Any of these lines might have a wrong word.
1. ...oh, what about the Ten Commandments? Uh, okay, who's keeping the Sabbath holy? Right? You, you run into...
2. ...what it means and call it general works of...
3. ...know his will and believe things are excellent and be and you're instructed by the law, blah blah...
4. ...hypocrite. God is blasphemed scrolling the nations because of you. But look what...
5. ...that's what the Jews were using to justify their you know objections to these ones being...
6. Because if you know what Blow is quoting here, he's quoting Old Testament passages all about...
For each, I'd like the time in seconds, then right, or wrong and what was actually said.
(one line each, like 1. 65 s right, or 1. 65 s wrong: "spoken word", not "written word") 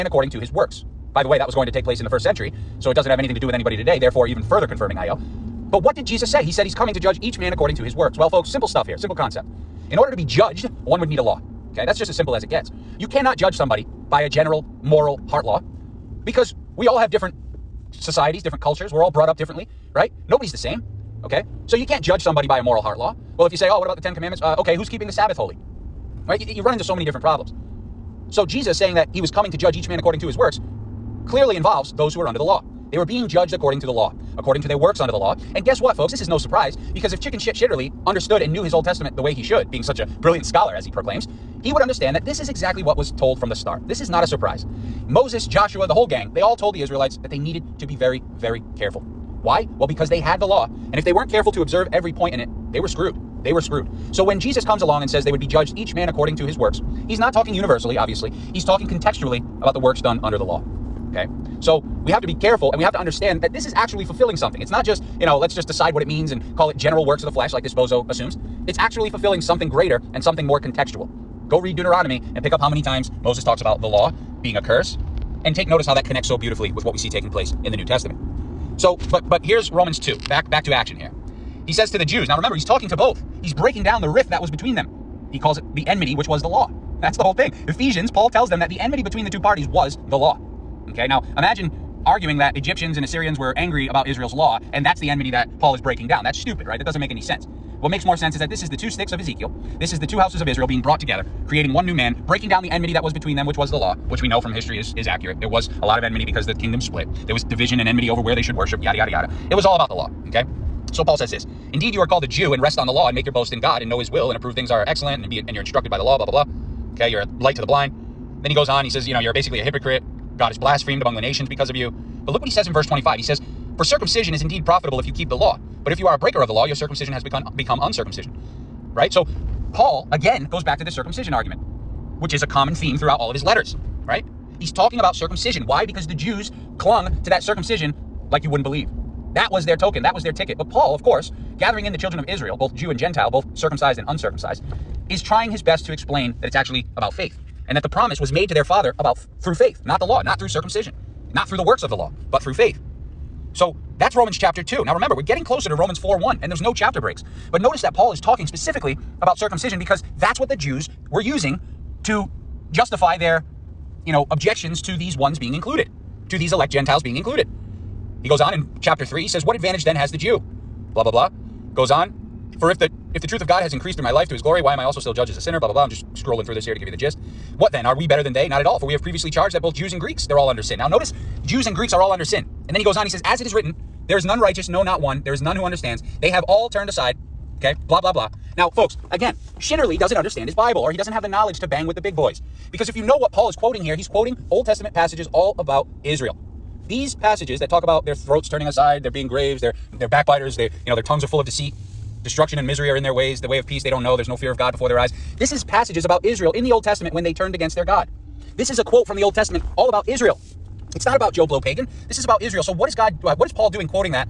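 1. 23 s right
2. 65 s right
3. 113 s wrong: "approve", not "believe"
4. 119 s wrong: "among", not "scrolling"
5. 160 s right
6. 192 s wrong: "Paul", not "Blow".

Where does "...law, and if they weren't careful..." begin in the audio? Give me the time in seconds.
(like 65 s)
50 s.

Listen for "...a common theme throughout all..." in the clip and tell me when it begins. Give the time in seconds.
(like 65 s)
132 s.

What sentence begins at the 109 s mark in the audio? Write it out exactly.
It was all about the law, okay?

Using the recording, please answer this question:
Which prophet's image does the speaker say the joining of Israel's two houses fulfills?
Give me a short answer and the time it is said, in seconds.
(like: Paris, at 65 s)
The two sticks of Ezekiel, at 98 s.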